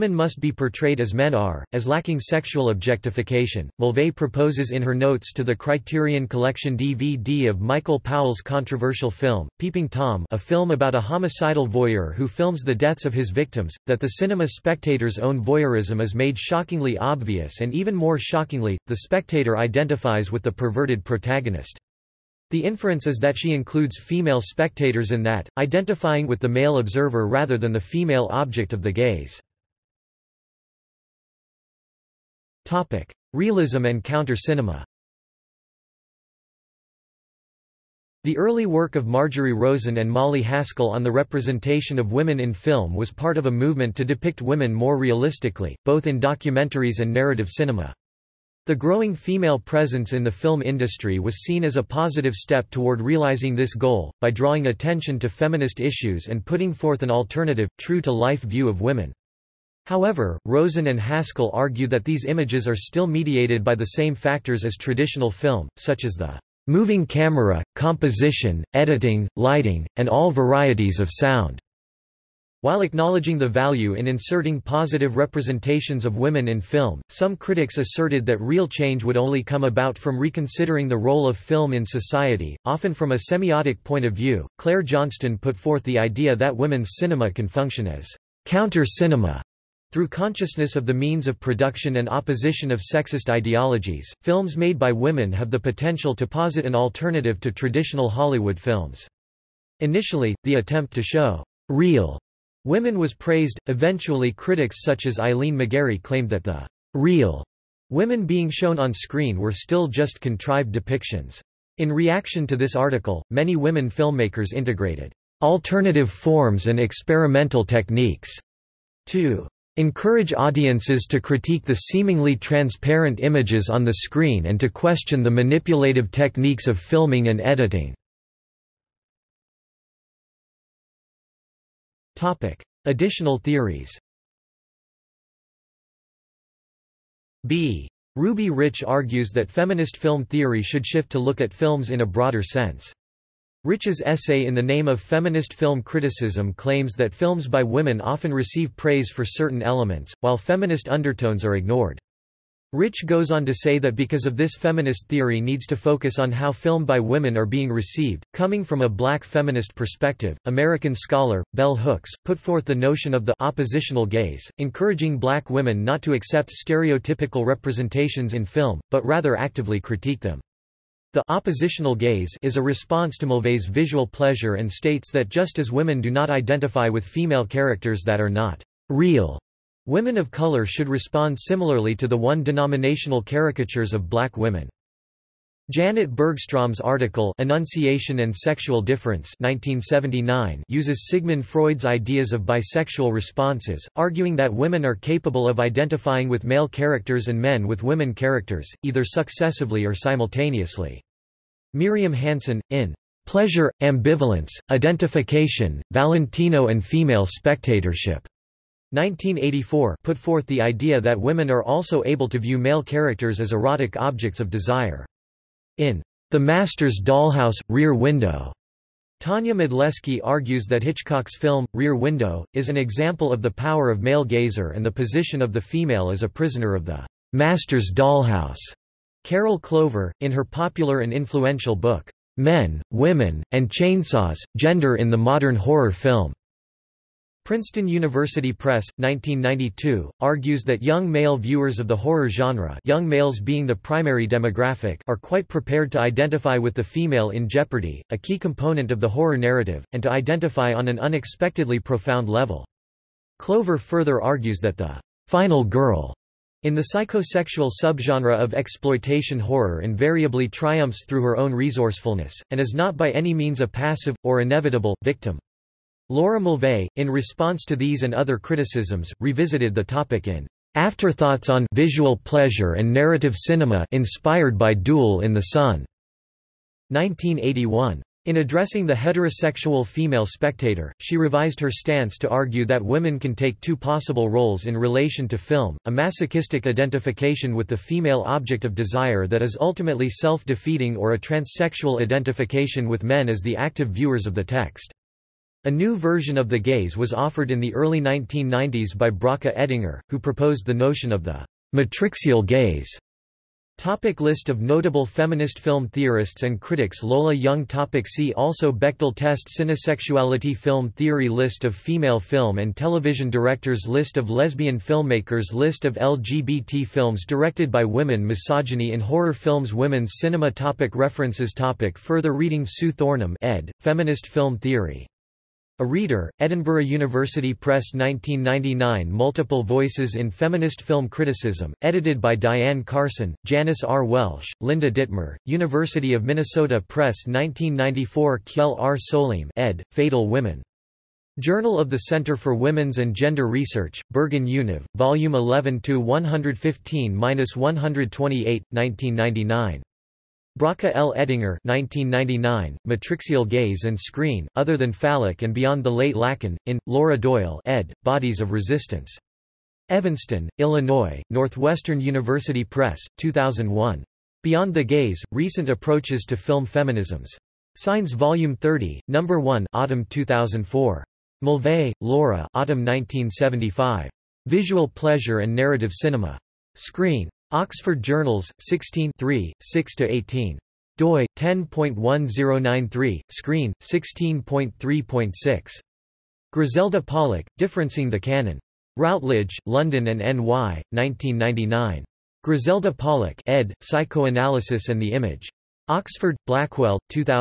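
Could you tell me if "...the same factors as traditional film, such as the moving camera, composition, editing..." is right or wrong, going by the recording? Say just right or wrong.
right.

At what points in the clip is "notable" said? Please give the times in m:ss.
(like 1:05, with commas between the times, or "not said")
5:04.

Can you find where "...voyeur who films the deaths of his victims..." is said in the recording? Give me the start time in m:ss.
0:11.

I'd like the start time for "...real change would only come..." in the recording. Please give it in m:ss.
1:18.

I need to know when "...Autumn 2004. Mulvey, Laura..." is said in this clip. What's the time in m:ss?
6:09.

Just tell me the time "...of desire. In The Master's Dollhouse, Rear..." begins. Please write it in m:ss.
3:34.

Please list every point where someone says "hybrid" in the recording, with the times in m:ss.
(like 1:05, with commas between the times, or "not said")
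not said.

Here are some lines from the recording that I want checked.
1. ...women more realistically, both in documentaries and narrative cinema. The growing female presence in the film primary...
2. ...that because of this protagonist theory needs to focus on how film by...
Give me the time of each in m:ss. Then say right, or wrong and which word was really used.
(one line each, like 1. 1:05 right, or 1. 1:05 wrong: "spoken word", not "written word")
1. 0:44 wrong: "industry", not "primary"
2. 2:33 wrong: "feminist", not "protagonist".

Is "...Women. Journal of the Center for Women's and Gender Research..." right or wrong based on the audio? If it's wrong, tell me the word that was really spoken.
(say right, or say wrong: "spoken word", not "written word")
right.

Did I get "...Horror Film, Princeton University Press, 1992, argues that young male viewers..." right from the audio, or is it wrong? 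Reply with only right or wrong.
right.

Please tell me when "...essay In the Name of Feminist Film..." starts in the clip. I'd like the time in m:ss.
2:24.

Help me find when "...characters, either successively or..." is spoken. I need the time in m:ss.
3:18.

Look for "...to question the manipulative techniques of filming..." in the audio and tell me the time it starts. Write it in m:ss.
2:04.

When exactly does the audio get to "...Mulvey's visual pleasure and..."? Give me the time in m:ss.
2:53.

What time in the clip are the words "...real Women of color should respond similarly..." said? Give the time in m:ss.
2:58.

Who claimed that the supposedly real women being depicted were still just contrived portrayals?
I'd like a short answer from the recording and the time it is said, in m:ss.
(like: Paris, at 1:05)
Eileen McGarry, at 1:45.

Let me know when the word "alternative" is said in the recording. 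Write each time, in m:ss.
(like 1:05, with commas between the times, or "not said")
0:57, 1:36, 1:55.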